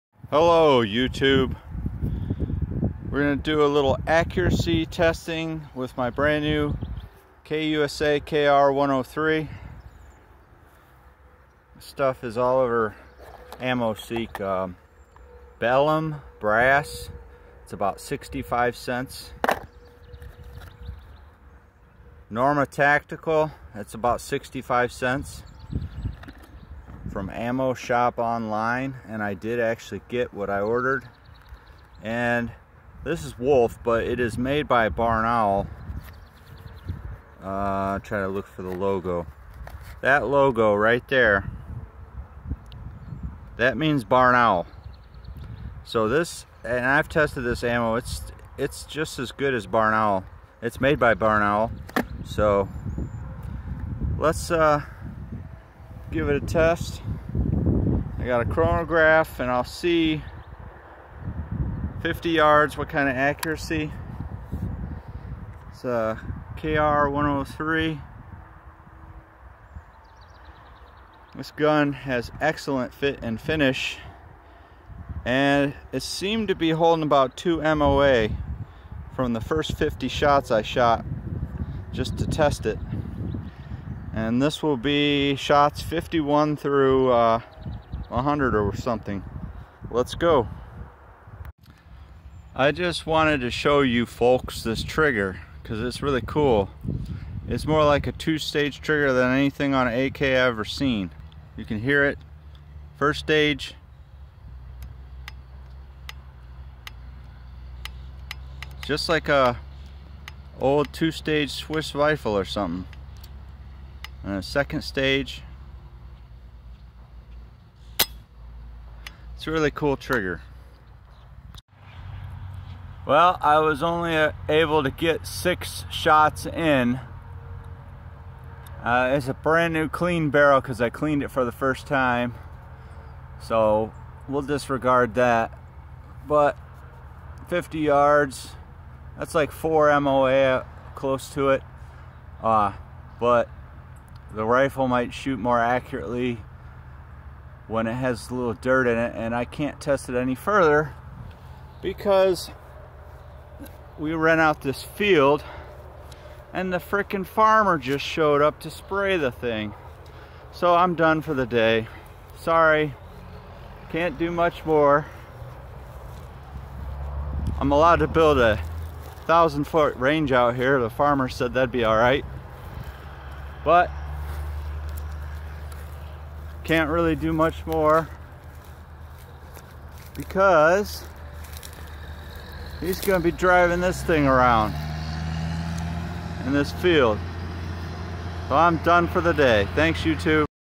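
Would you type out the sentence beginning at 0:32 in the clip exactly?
And this is Wolf, but it is made by Barnaul.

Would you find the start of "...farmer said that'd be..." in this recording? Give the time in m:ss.
2:50.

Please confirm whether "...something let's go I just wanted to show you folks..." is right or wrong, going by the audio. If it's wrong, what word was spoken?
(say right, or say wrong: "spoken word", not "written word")
right.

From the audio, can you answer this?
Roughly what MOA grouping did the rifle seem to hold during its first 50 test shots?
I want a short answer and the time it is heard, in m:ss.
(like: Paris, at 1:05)
2 MOA, at 1:17.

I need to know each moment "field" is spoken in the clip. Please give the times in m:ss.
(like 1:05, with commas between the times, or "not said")
2:34, 3:06.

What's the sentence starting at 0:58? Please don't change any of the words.
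I got a chronograph and I'll see 50 yards what kind of accuracy.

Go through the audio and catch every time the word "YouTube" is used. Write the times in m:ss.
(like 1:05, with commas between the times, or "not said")
0:00, 3:10.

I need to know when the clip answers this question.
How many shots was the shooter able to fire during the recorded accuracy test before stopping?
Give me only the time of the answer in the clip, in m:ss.
2:05.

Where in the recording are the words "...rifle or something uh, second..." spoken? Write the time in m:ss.
1:51.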